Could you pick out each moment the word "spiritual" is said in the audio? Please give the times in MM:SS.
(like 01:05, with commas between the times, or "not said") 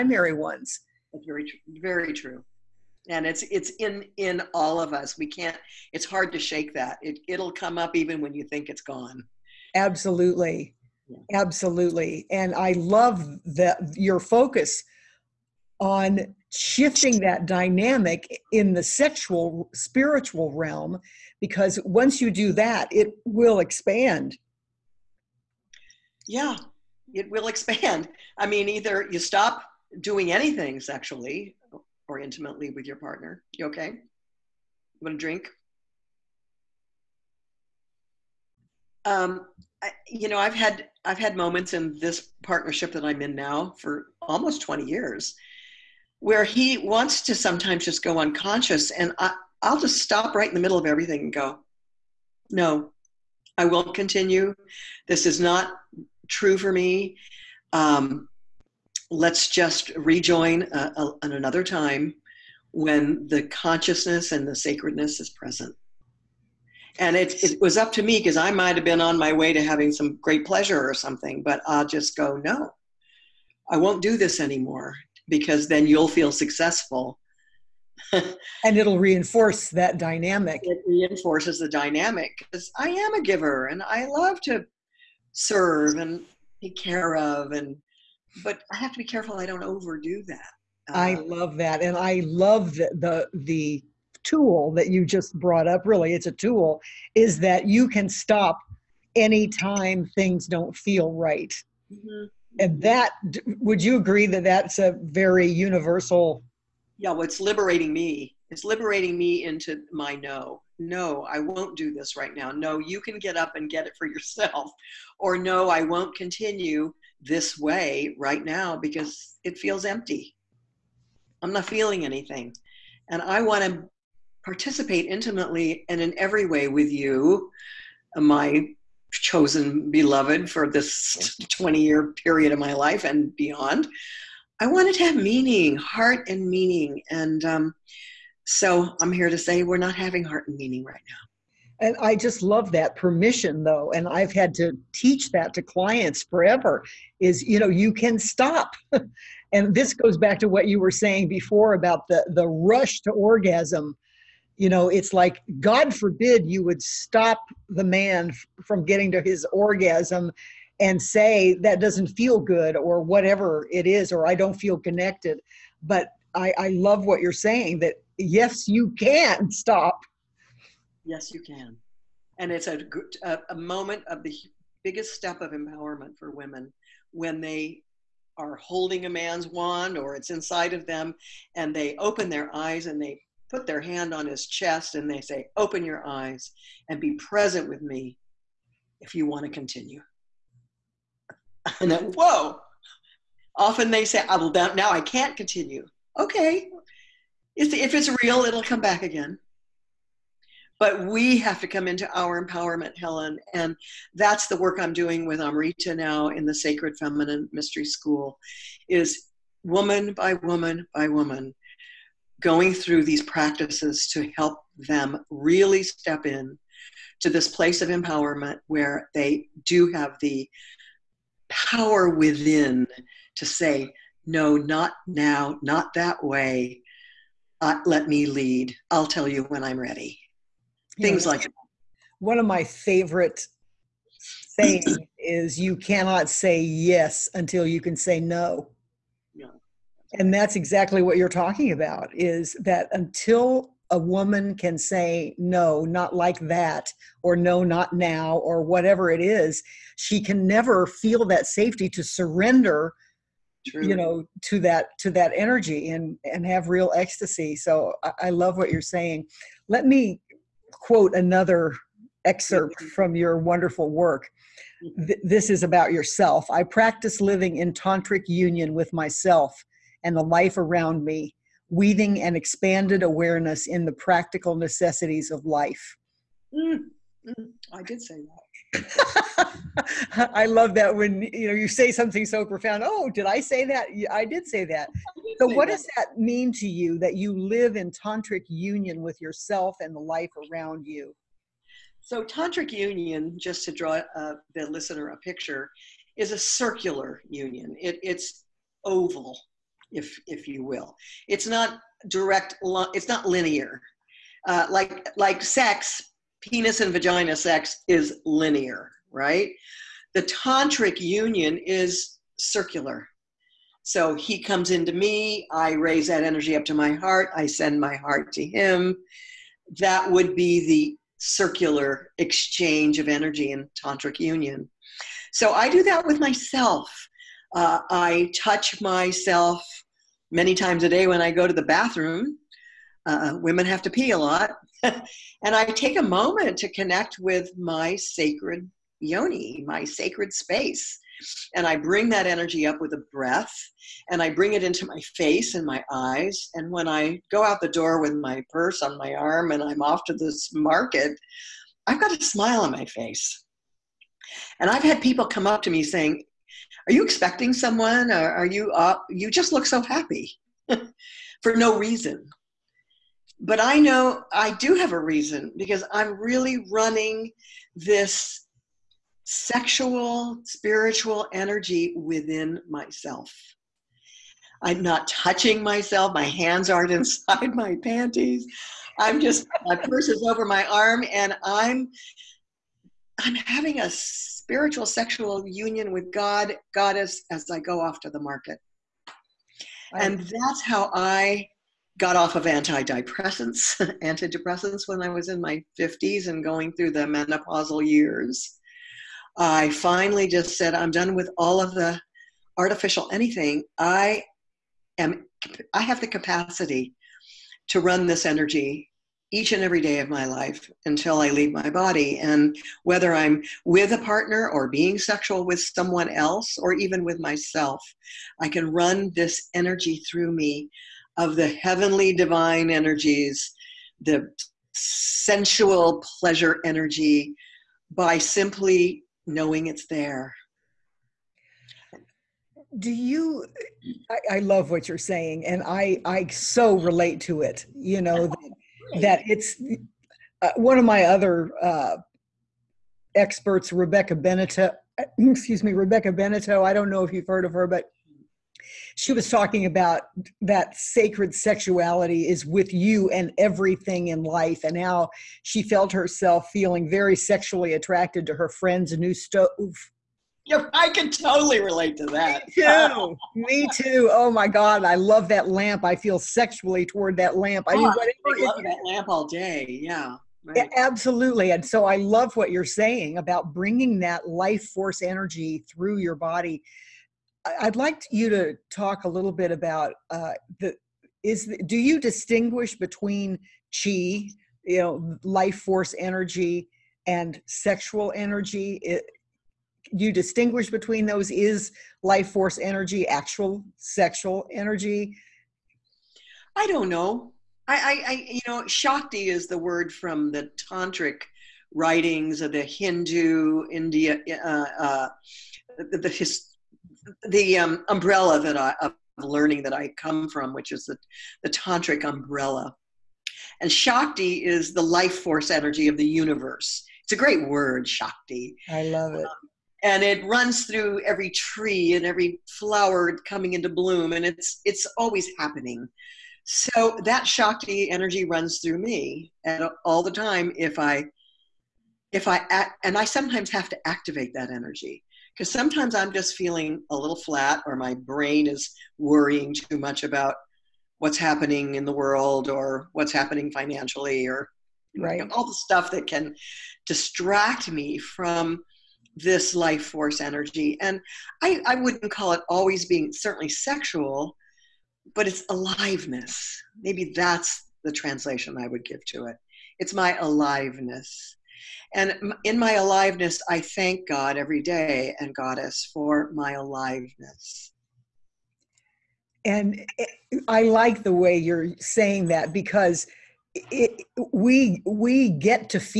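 00:19, 06:10, 06:23.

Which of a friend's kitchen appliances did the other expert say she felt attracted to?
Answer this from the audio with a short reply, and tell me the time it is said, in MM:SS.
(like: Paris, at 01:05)
stove, at 07:39.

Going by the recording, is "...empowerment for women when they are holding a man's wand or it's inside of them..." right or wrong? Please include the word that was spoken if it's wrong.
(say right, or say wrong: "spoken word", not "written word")
right.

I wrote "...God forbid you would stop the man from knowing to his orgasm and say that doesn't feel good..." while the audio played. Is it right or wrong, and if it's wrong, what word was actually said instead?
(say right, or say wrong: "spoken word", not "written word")
wrong: "getting", not "knowing".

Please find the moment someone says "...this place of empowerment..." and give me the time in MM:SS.
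03:37.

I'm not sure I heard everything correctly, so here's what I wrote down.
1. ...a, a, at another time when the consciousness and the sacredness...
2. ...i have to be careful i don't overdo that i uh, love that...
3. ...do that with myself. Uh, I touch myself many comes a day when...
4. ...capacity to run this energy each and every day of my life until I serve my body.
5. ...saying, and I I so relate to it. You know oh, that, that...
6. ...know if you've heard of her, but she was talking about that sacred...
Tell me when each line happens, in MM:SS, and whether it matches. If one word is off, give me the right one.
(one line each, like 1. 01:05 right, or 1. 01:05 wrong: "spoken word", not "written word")
1. 01:00 right
2. 01:28 right
3. 05:25 wrong: "times", not "comes"
4. 06:46 wrong: "leave", not "serve"
5. 07:14 right
6. 07:26 right.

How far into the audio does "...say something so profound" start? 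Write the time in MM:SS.
04:41.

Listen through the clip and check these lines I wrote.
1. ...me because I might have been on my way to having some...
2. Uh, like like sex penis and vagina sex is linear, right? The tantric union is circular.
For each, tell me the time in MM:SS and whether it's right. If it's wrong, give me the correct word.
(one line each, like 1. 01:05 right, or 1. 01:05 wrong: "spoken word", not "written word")
1. 01:08 right
2. 05:04 right.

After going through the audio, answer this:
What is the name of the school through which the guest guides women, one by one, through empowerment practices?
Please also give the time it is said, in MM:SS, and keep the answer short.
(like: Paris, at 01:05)
Sacred Feminine Mystery School, at 03:26.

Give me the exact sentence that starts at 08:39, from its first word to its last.
Um, and it runs through every tree and every flower coming into bloom, and it's it's always happening.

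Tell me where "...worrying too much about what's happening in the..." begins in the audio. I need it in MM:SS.
08:58.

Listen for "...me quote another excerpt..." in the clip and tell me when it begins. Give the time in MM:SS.
04:19.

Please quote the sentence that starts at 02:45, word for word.
But I, I love what you're saying that yes, you can stop.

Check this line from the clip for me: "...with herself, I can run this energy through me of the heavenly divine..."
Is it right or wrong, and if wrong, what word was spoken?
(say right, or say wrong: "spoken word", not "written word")
wrong: "myself", not "herself".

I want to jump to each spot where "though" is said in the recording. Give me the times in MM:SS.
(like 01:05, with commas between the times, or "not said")
02:23.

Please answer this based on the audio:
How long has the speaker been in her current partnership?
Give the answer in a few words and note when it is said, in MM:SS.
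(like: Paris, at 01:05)
almost 20 years, at 00:44.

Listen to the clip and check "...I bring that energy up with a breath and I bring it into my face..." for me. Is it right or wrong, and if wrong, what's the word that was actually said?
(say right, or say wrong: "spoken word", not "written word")
right.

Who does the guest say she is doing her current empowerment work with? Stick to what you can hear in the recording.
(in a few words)
Amrita.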